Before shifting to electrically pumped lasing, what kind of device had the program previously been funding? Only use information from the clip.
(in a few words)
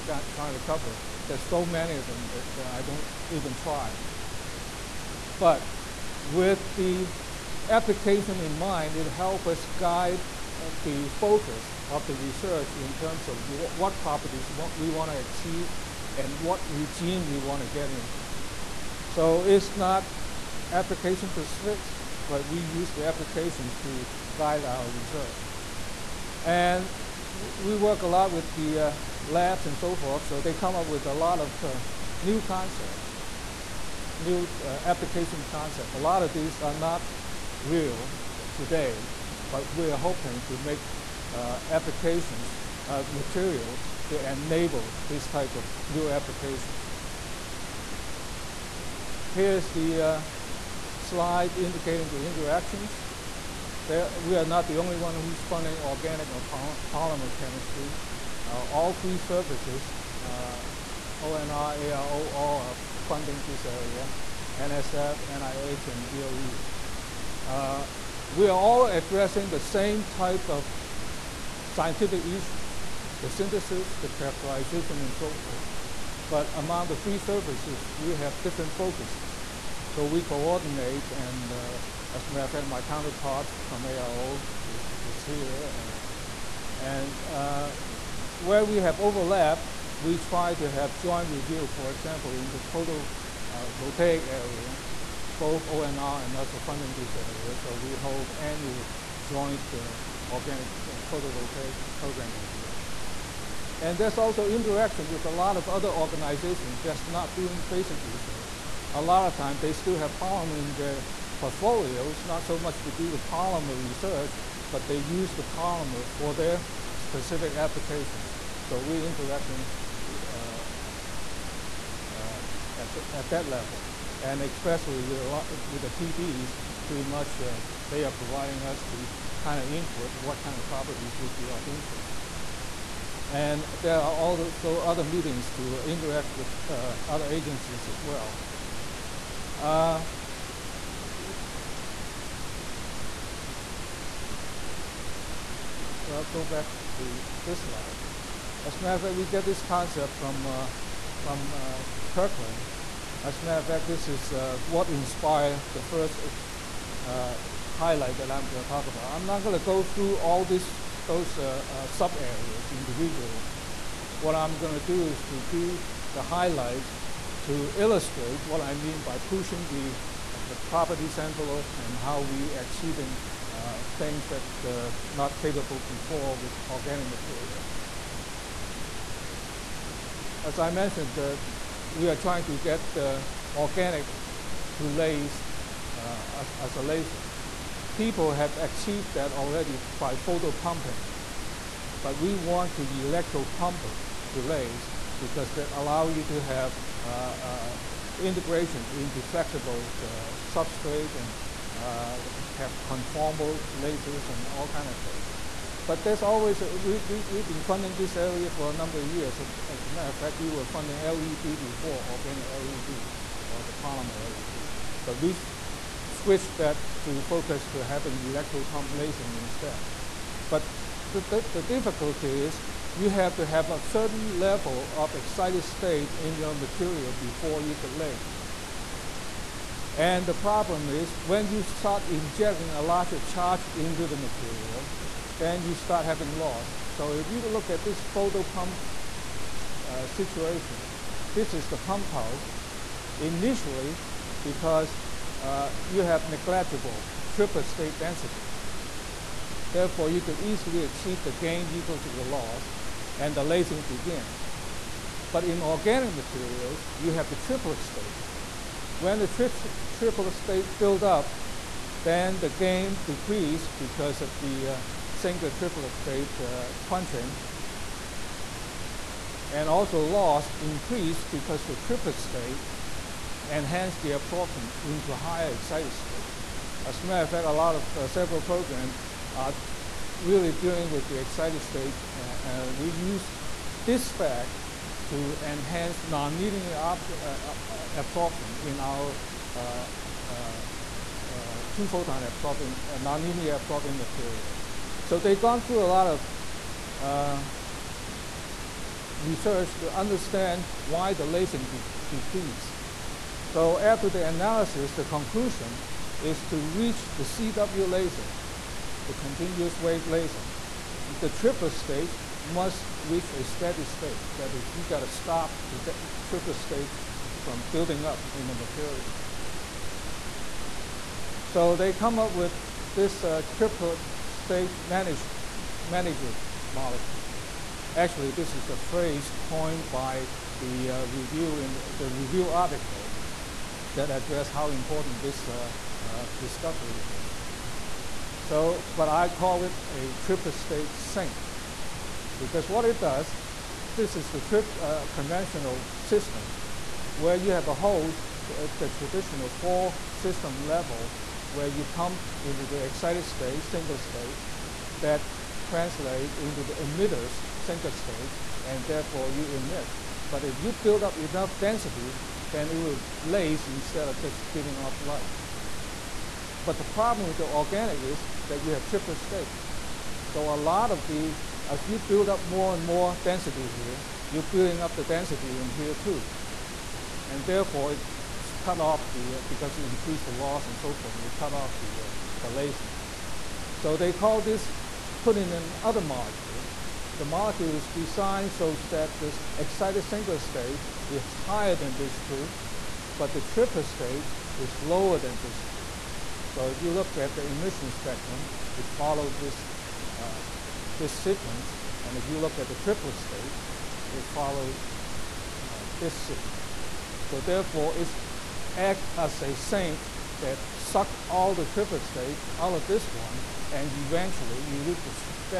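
Organic LED.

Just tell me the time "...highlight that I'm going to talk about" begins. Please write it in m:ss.
2:37.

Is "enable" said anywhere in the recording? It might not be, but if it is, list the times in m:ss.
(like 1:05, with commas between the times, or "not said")
0:44.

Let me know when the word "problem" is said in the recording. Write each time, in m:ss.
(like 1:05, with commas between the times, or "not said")
3:50, 6:06.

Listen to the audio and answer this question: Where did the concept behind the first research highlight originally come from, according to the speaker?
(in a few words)
Kirtland.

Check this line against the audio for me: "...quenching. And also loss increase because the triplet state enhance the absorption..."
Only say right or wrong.
right.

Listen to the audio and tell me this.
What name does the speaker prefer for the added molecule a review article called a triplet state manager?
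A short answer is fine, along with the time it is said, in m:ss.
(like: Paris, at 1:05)
Triplet state sink, at 5:40.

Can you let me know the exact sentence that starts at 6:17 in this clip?
And therefore, it cut off the, uh, because it increased the loss and so forth, it cut off the, uh, the lasing.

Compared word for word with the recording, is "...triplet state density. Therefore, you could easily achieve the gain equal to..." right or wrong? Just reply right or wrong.
right.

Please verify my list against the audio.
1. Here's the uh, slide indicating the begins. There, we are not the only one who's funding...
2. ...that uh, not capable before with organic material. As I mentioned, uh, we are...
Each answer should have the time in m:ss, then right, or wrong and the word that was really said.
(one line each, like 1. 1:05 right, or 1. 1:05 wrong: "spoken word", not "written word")
1. 0:49 wrong: "interactions", not "begins"
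2. 2:54 right.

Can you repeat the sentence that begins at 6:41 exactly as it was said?
And if you look at the triplet state, it follows uh, this sequence.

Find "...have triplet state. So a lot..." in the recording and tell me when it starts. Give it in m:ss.
6:08.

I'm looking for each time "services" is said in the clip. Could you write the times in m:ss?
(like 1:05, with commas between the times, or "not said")
0:59, 1:17.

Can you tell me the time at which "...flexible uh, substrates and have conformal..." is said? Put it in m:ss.
3:19.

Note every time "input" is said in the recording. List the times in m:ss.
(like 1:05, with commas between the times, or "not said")
2:09.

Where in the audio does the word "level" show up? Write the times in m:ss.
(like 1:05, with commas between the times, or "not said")
2:03, 3:44, 5:50.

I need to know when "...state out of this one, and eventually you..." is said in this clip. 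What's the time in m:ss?
6:52.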